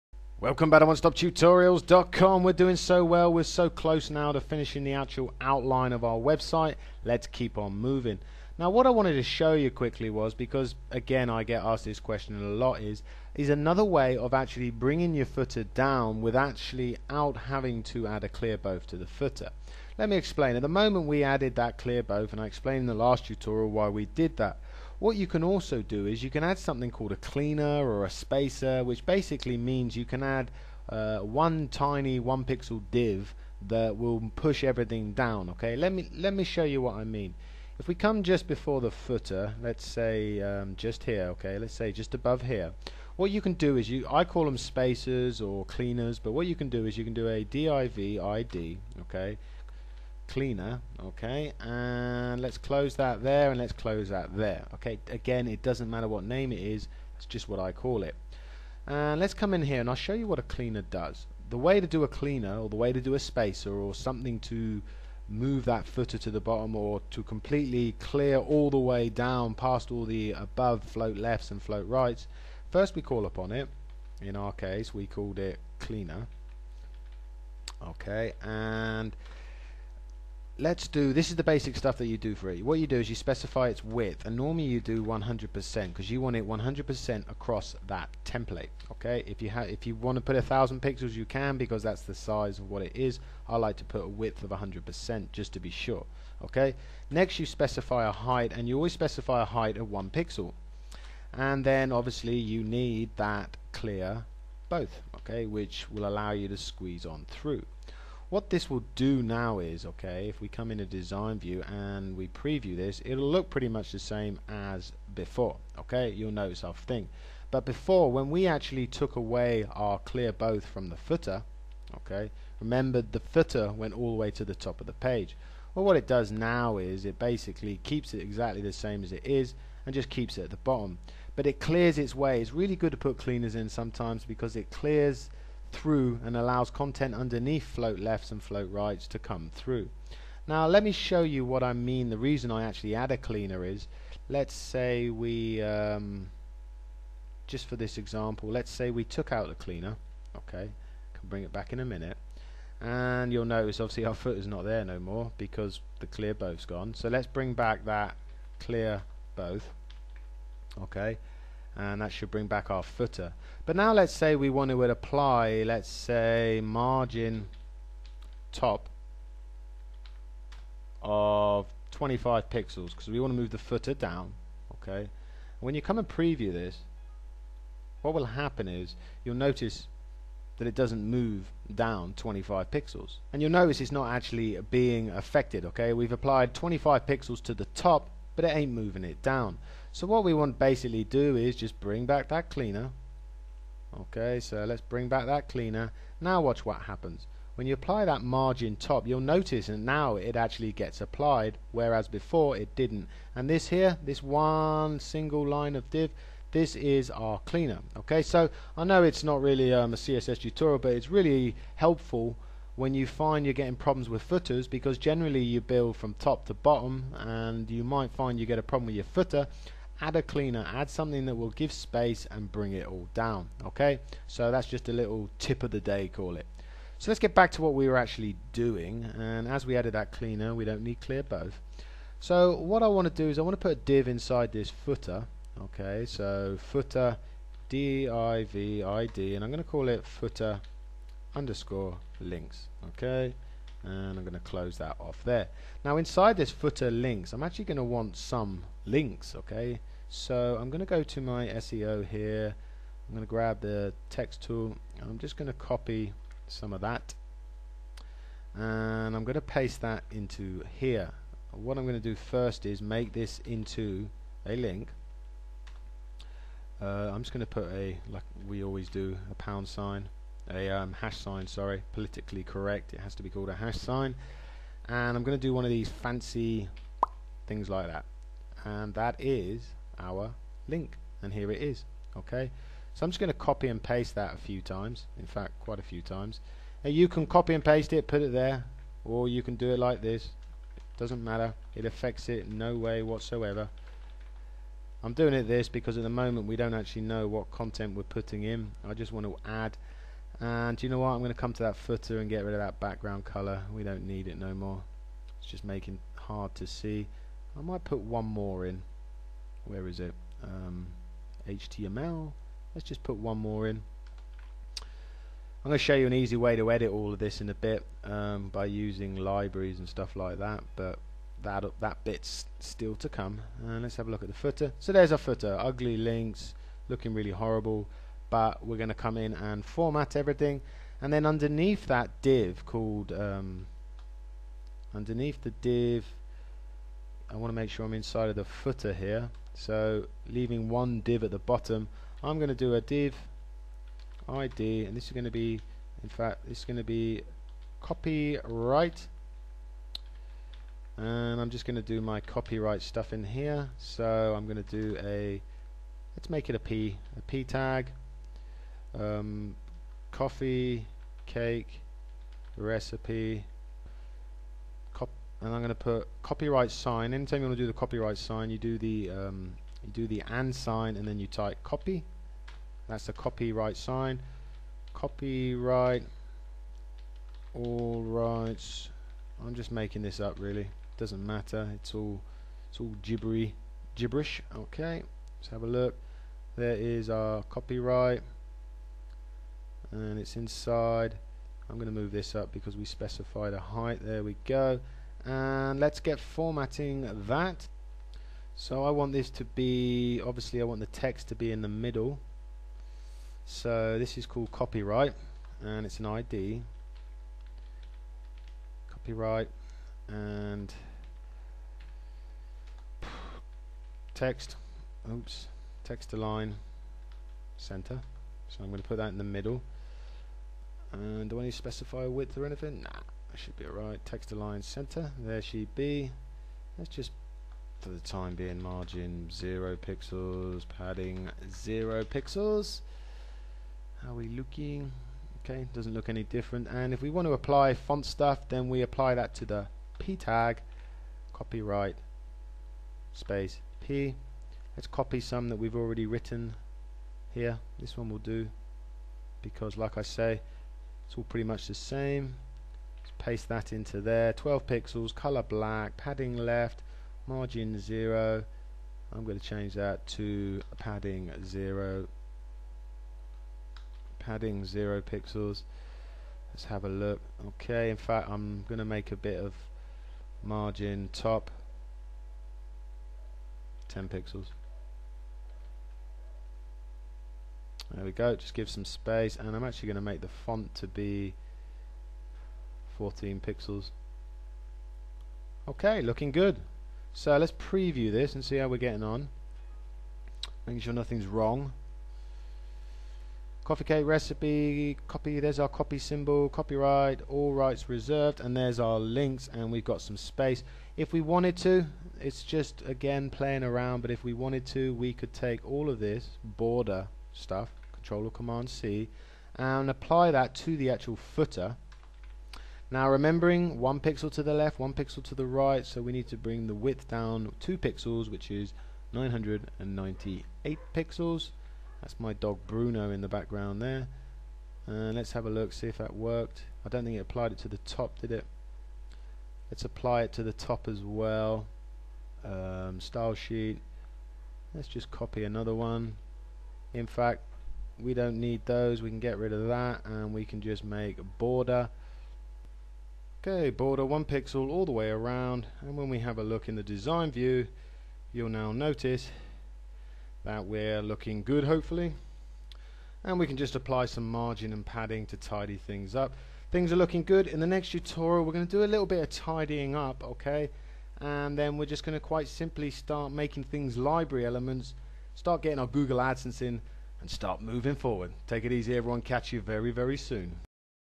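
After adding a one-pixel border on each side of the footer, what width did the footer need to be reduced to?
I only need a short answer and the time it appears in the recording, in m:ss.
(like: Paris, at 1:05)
998 pixels, at 8:39.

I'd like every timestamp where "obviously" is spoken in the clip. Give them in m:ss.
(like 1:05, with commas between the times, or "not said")
1:41, 2:33, 6:40.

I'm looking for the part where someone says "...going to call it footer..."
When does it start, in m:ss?
3:59.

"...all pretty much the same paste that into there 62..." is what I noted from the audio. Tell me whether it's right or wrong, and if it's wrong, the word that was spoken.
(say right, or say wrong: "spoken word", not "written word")
wrong: "12", not "62".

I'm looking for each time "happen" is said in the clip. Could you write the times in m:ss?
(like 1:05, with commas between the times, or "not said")
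2:58, 3:16.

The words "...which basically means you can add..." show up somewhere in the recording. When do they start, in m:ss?
0:28.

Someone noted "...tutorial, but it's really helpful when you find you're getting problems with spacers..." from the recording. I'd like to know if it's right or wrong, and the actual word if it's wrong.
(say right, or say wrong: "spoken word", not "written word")
wrong: "footers", not "spacers".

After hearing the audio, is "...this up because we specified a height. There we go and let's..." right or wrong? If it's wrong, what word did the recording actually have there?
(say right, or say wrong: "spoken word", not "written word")
right.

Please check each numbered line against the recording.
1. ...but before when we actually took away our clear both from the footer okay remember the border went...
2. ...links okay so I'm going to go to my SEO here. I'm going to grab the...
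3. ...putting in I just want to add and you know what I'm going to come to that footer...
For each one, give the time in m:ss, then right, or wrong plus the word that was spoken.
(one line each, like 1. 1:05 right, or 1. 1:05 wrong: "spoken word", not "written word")
1. 1:57 wrong: "footer", not "border"
2. 4:08 right
3. 4:58 right.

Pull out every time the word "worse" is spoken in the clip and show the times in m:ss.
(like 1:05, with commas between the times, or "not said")
not said.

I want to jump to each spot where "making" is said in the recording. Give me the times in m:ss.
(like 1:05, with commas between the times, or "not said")
5:05, 6:19, 8:10, 9:23.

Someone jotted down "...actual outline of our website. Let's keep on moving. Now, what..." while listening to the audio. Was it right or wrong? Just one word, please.
right.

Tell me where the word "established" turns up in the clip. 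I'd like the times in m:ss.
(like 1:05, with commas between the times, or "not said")
not said.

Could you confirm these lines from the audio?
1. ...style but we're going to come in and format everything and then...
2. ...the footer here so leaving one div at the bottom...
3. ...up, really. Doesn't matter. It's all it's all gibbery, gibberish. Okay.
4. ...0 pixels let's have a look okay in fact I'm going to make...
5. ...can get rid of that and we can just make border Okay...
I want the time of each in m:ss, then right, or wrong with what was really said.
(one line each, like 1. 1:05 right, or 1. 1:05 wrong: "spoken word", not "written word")
1. 5:27 wrong: "horrible", not "style"
2. 5:38 right
3. 6:20 right
4. 7:44 right
5. 8:59 right.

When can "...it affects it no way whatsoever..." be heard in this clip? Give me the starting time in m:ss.
4:51.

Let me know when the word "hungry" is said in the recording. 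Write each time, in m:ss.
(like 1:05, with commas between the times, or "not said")
not said.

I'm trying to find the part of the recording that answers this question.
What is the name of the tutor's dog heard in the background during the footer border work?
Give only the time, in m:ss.
8:42.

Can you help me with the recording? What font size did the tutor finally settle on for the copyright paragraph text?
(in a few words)
14 pixels.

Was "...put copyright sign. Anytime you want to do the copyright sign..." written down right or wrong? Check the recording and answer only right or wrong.
right.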